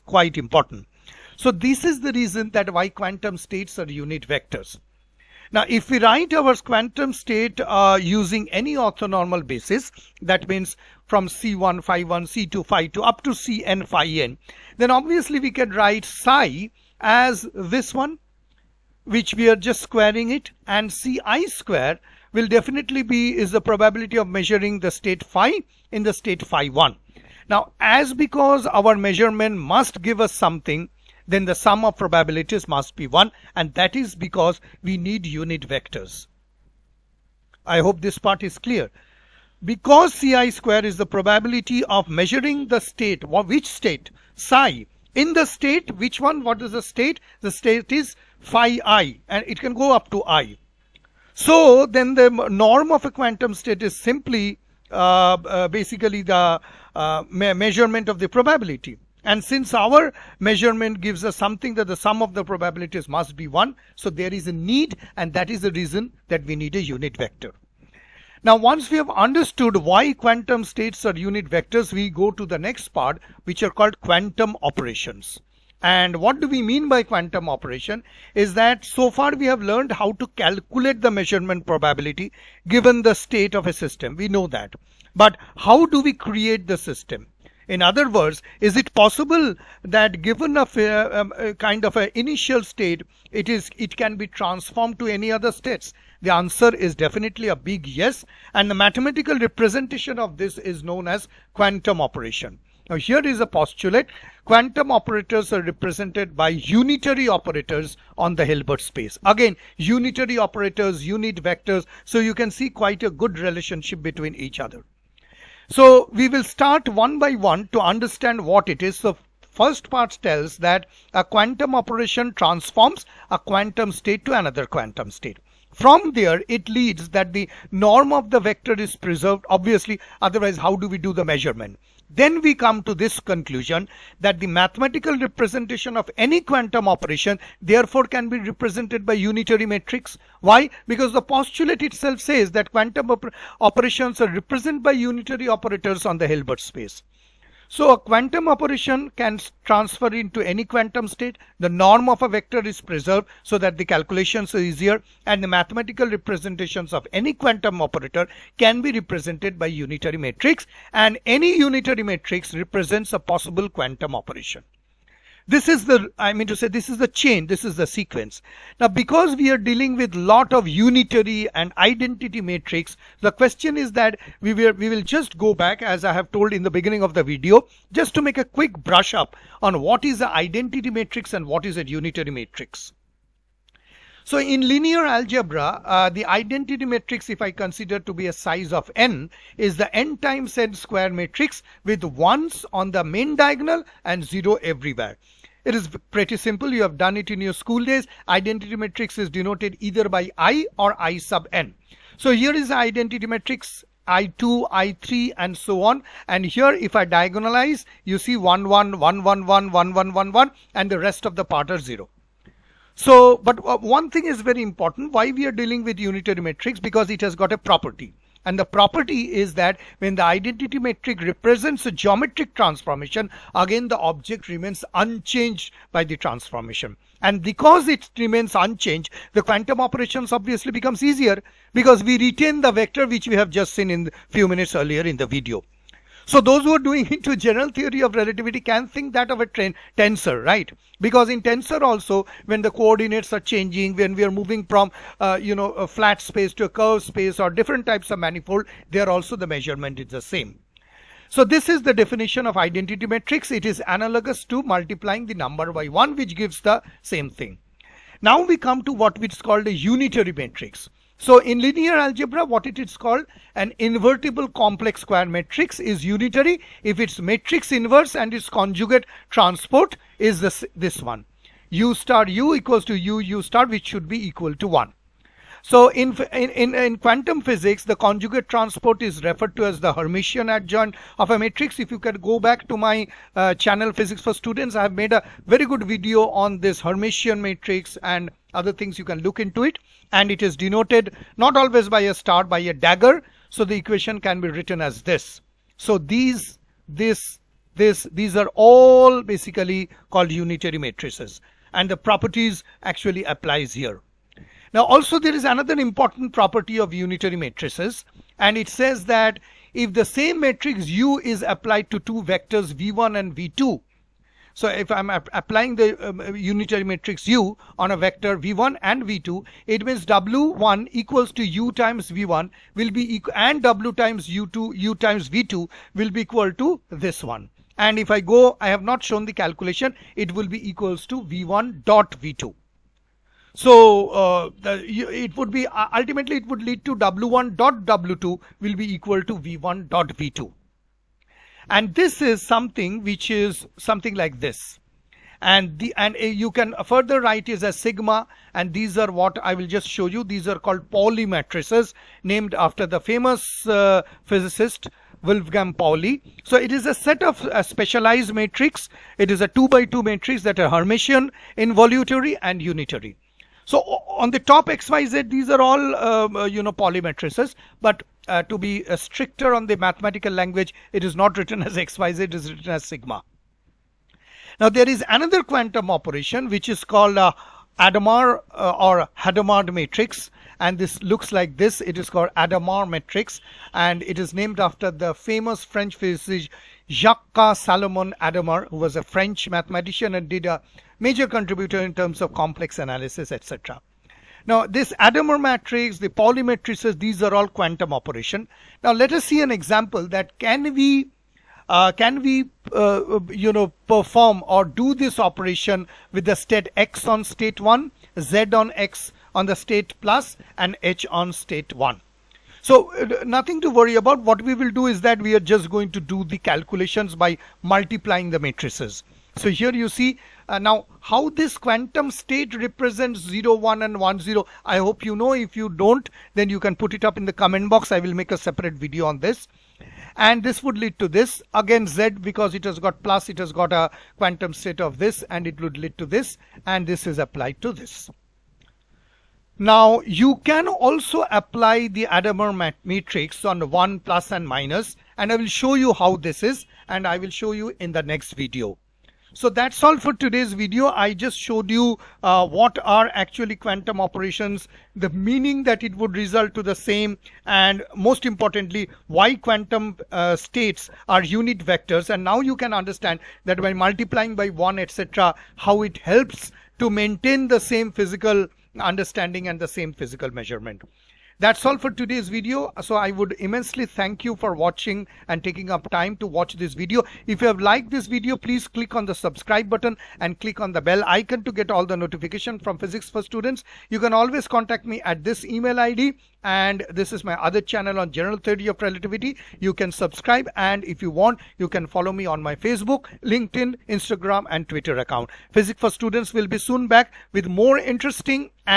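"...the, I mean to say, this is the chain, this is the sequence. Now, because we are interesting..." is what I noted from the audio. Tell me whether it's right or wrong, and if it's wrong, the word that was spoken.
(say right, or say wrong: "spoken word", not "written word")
wrong: "dealing", not "interesting".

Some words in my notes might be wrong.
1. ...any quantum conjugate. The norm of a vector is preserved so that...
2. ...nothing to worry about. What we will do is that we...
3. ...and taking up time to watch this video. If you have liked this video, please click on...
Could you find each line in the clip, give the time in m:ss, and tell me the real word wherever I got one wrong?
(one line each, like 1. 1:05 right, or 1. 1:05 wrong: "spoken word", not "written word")
1. 2:30 wrong: "state", not "conjugate"
2. 6:53 right
3. 7:55 right.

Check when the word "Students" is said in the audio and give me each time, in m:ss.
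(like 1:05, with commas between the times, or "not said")
4:44, 8:03, 8:15.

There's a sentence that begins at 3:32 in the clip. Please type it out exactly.
So, but uh, one thing is very important why we are dealing with unitary matrix because it has got a property.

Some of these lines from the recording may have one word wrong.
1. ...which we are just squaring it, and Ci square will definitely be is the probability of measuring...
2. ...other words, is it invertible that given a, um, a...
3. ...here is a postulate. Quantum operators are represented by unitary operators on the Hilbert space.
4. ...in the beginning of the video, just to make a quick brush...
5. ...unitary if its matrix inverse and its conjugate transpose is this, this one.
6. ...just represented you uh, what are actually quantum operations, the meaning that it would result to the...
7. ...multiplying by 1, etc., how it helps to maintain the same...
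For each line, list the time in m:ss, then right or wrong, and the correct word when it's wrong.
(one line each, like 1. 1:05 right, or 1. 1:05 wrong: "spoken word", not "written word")
1. 0:19 right
2. 1:27 wrong: "possible", not "invertible"
3. 1:42 right
4. 2:56 right
5. 4:26 right
6. 7:31 wrong: "showed", not "represented"
7. 7:43 right.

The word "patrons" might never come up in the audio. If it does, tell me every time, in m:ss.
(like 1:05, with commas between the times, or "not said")
not said.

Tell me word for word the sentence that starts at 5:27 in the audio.
And if I go, I have not shown the calculation, it will be equals to V1 dot V2.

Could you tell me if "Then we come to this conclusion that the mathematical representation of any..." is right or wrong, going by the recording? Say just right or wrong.
right.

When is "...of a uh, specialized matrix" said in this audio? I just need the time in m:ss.
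5:57.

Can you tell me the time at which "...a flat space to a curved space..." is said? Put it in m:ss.
4:05.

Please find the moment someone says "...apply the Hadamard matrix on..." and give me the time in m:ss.
7:21.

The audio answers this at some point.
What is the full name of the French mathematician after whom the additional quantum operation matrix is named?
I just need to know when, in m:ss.
6:26.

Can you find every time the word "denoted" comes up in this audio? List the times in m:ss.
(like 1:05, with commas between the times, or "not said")
3:19, 4:50.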